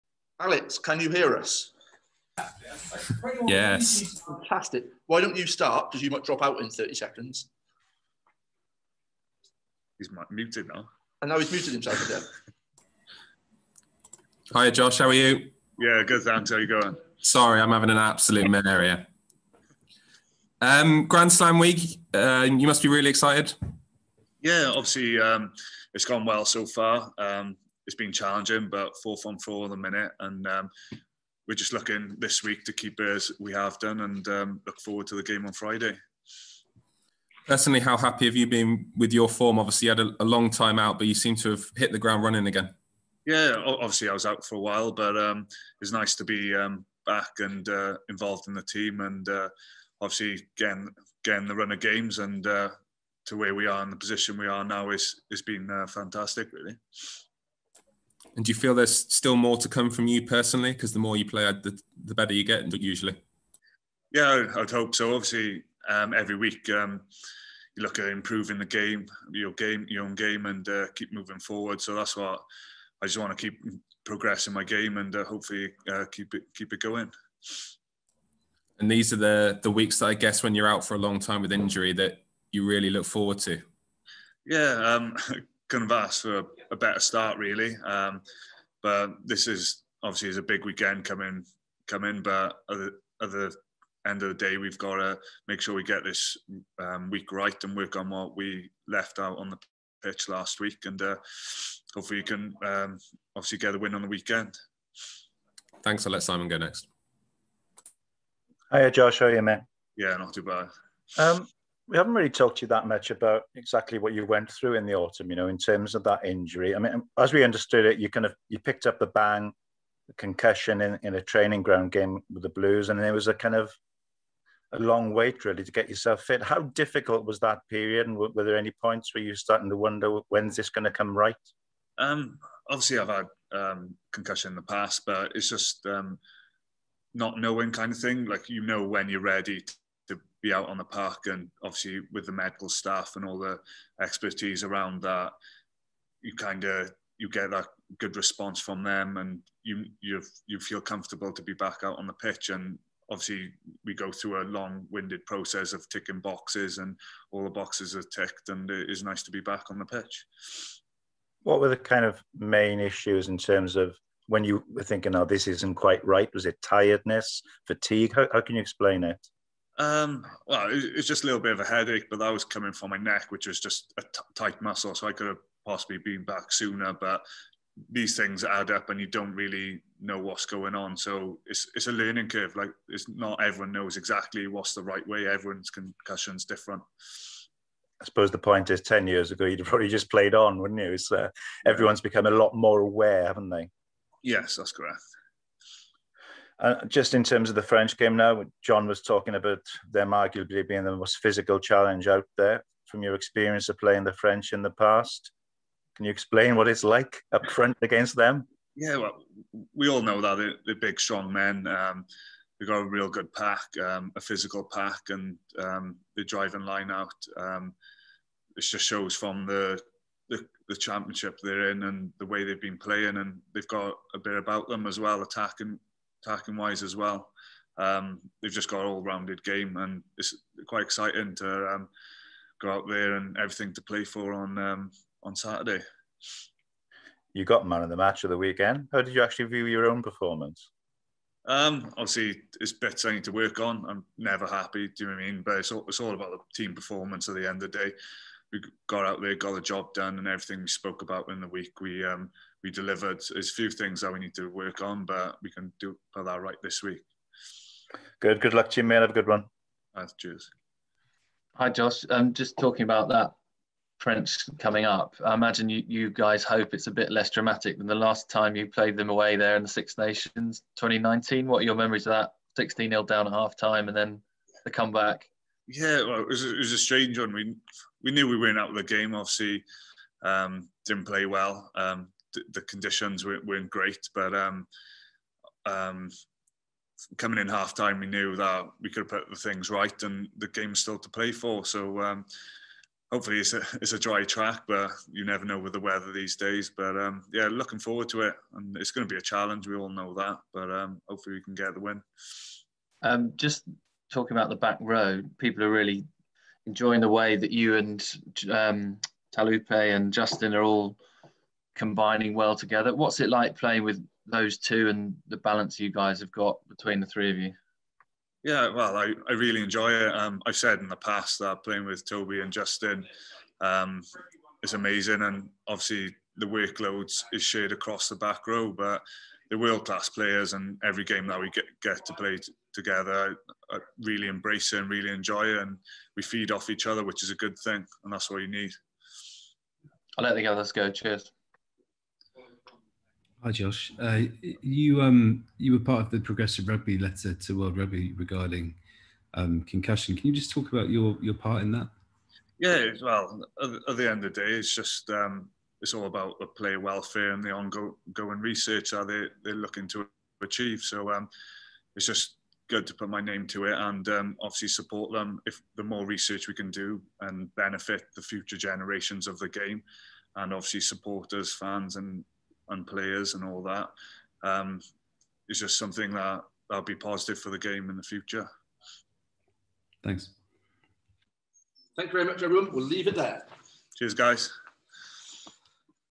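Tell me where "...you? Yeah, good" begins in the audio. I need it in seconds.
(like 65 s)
15 s.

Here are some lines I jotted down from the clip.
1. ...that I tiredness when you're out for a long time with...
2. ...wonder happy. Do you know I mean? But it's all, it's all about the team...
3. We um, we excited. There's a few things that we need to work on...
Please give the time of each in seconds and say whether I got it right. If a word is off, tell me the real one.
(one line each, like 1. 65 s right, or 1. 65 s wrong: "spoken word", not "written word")
1. 79 s wrong: "guess", not "tiredness"
2. 244 s wrong: "never", not "wonder"
3. 251 s wrong: "delivered", not "excited".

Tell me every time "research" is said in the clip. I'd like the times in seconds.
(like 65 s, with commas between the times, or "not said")
358 s, 366 s.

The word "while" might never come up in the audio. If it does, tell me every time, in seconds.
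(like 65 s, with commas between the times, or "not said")
44 s.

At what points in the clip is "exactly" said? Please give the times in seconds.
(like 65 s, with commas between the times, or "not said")
113 s, 183 s.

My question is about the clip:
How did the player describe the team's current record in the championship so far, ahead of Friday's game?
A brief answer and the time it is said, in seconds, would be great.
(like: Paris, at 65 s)
4 from 4, at 29 s.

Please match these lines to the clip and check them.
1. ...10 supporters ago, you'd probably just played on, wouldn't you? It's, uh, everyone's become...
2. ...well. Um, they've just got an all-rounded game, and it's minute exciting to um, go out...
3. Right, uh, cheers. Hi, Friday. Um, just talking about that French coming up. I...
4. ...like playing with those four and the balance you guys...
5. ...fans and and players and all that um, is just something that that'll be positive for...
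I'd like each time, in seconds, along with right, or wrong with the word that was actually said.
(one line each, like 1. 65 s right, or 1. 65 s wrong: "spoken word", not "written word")
1. 188 s wrong: "years", not "supporters"
2. 226 s wrong: "quite", not "minute"
3. 259 s wrong: "Josh", not "Friday"
4. 313 s wrong: "two", not "four"
5. 371 s right.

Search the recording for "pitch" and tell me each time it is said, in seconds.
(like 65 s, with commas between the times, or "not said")
100 s, 152 s, 159 s.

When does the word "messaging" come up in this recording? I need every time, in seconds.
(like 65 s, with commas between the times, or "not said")
not said.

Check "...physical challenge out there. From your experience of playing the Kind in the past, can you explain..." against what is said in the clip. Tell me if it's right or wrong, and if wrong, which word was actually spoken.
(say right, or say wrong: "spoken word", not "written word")
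wrong: "French", not "Kind".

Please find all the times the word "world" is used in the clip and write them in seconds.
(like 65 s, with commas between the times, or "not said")
329 s, 347 s.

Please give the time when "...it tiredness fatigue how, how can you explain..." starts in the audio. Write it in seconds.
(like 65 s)
166 s.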